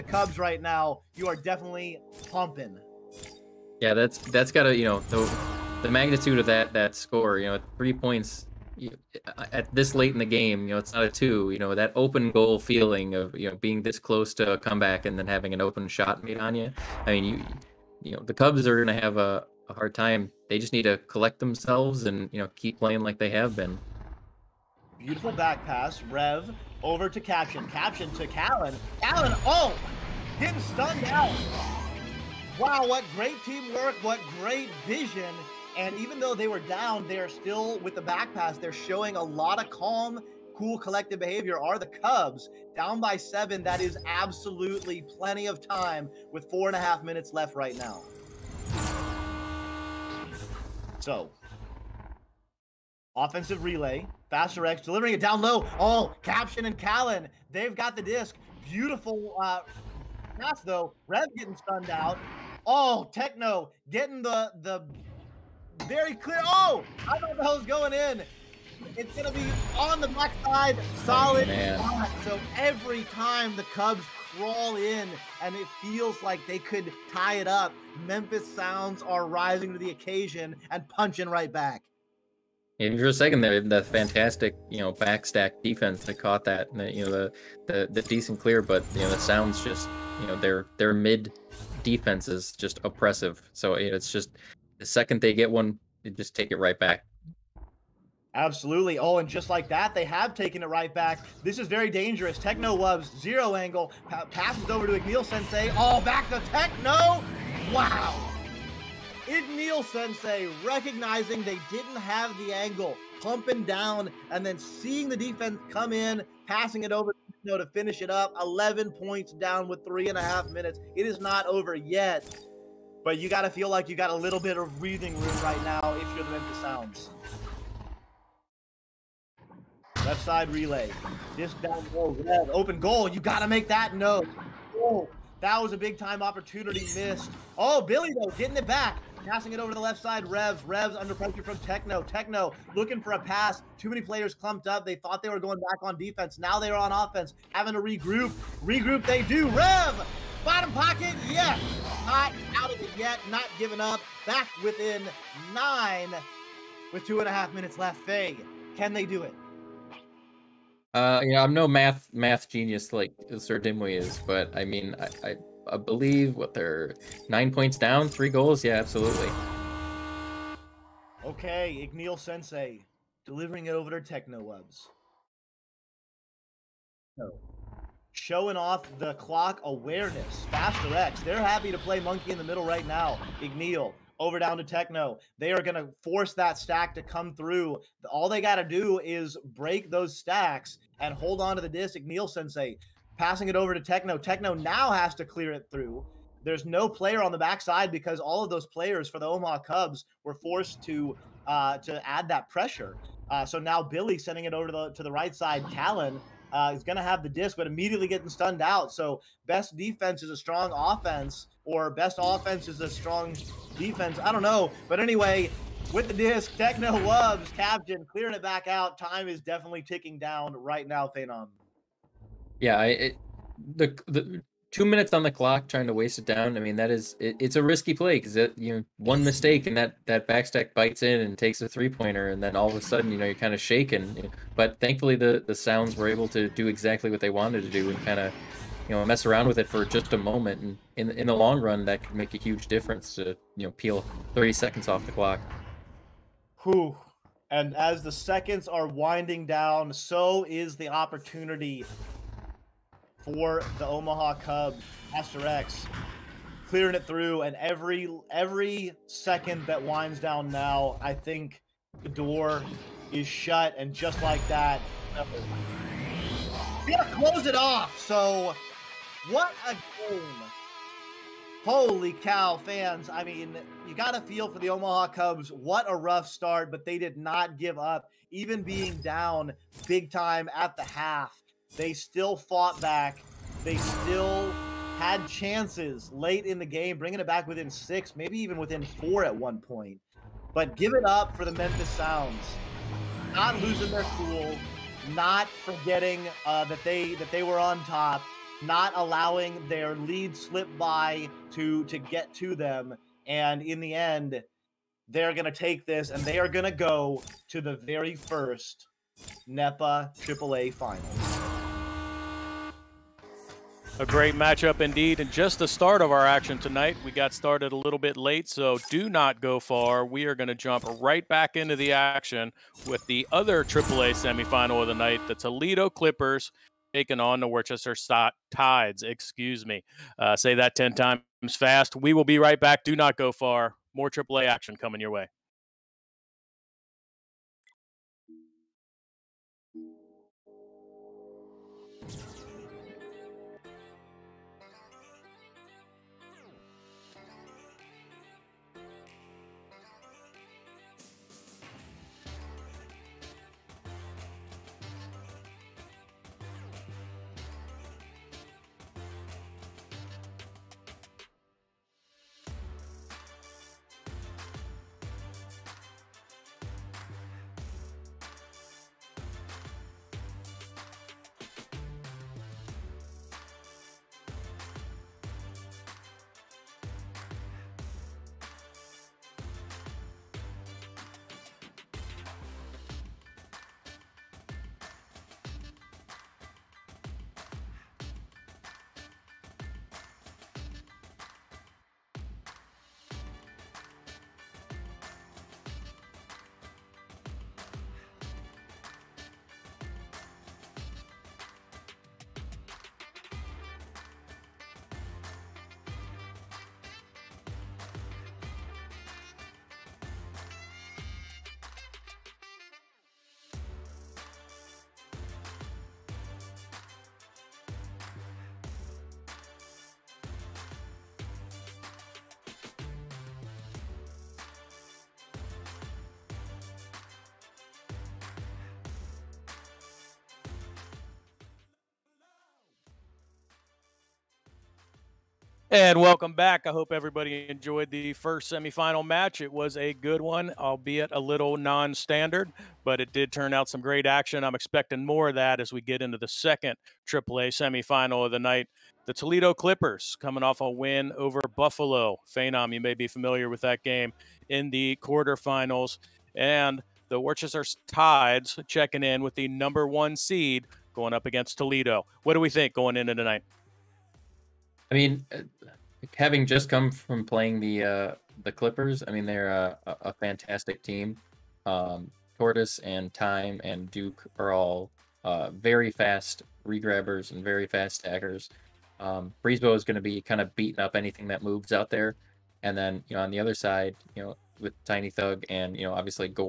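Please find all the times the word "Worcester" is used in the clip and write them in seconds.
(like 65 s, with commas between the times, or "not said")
327 s, 457 s.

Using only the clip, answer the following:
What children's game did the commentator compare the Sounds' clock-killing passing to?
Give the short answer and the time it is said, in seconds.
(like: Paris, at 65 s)
Monkey in the middle, at 181 s.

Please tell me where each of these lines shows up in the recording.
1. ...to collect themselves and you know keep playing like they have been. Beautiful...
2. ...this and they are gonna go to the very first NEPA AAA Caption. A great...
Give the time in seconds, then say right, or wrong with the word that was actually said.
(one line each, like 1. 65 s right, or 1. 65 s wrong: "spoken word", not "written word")
1. 20 s right
2. 305 s wrong: "Finals", not "Caption".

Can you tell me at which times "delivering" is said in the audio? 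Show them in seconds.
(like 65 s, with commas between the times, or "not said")
54 s, 173 s.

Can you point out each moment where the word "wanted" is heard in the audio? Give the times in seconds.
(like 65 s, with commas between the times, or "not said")
237 s.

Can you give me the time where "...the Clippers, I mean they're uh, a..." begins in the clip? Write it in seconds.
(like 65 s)
468 s.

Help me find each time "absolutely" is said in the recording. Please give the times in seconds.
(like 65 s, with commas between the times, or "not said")
44 s, 98 s, 168 s.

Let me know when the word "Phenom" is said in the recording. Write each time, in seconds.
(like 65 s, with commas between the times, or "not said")
221 s, 452 s.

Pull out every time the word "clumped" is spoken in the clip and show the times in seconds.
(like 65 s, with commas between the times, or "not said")
144 s.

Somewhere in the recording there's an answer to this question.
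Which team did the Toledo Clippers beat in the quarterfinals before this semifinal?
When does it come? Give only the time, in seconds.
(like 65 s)
451 s.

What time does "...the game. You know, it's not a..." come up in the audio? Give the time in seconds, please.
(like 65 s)
10 s.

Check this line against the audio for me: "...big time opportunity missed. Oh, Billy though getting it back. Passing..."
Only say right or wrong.
right.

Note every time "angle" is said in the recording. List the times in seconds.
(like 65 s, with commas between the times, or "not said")
103 s, 112 s.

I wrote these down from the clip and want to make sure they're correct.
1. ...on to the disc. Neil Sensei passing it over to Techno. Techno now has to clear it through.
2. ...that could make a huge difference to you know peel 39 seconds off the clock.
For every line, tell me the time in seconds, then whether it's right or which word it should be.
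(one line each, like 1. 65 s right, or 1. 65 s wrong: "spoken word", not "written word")
1. 191 s right
2. 241 s wrong: "30", not "39".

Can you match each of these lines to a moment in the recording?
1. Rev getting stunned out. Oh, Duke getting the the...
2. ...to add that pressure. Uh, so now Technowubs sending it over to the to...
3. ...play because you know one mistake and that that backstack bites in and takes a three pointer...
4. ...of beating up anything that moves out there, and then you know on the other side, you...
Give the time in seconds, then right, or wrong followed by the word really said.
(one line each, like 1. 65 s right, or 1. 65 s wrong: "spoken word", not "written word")
1. 61 s wrong: "Techno", not "Duke"
2. 201 s wrong: "Billy", not "Technowubs"
3. 227 s right
4. 480 s right.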